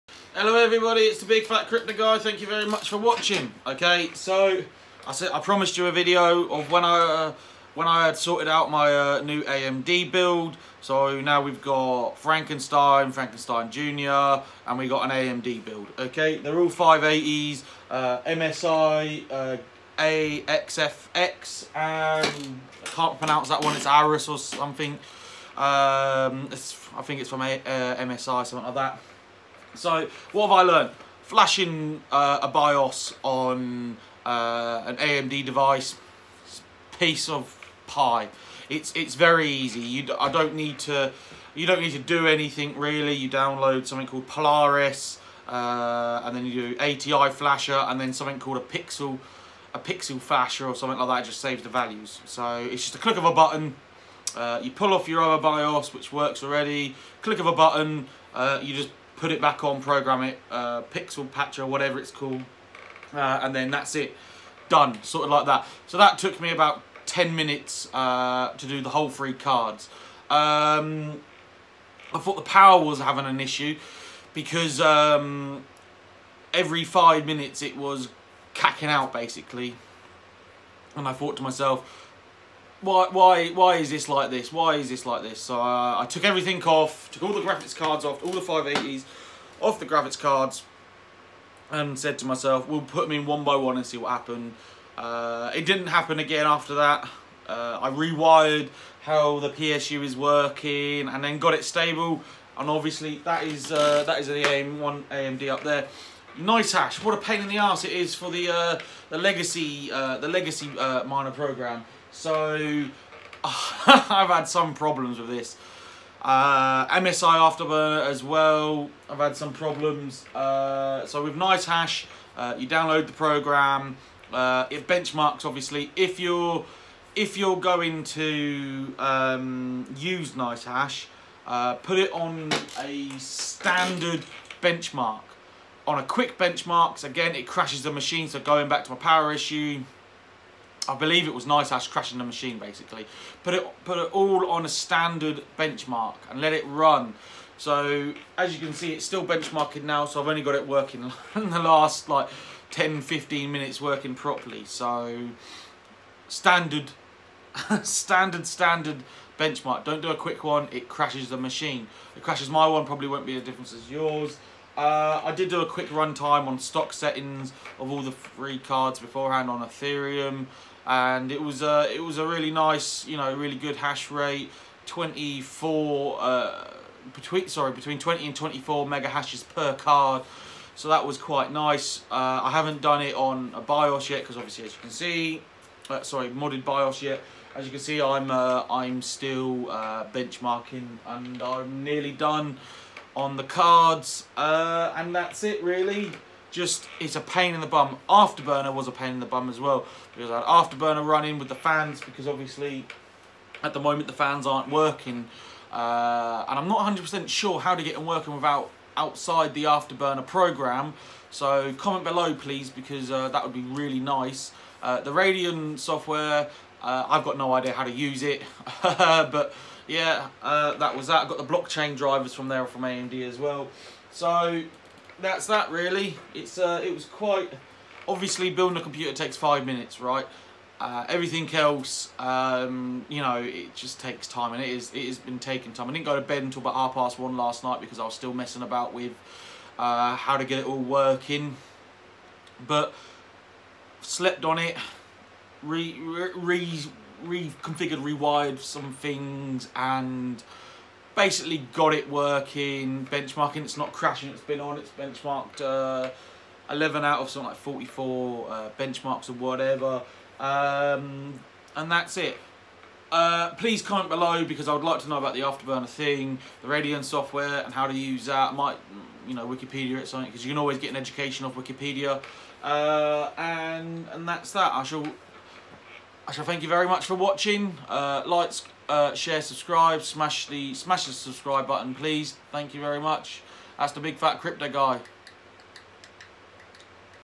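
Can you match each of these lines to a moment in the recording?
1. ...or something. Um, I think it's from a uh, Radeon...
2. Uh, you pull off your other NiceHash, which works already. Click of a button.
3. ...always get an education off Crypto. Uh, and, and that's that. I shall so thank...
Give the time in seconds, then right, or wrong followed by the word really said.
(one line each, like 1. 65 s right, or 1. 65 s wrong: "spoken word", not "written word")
1. 24 s wrong: "MSI", not "Radeon"
2. 54 s wrong: "BIOS", not "NiceHash"
3. 270 s wrong: "Wikipedia", not "Crypto".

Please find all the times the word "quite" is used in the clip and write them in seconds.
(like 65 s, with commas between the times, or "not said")
181 s, 227 s.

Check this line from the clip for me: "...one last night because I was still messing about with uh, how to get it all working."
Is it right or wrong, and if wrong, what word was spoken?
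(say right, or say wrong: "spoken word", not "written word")
right.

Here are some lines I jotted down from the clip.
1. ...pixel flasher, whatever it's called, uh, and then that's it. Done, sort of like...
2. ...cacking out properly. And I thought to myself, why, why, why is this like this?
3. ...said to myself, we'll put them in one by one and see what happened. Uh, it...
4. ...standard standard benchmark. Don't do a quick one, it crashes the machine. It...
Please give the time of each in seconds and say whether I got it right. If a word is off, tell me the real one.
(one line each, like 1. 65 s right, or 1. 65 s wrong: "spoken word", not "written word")
1. 60 s wrong: "patcher", not "flasher"
2. 78 s wrong: "basically", not "properly"
3. 91 s right
4. 157 s right.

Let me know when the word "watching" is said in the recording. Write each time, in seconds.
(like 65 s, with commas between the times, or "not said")
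2 s, 277 s.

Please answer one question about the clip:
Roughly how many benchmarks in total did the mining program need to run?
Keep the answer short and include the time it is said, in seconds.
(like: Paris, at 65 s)
44, at 257 s.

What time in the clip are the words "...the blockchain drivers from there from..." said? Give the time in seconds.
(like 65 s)
221 s.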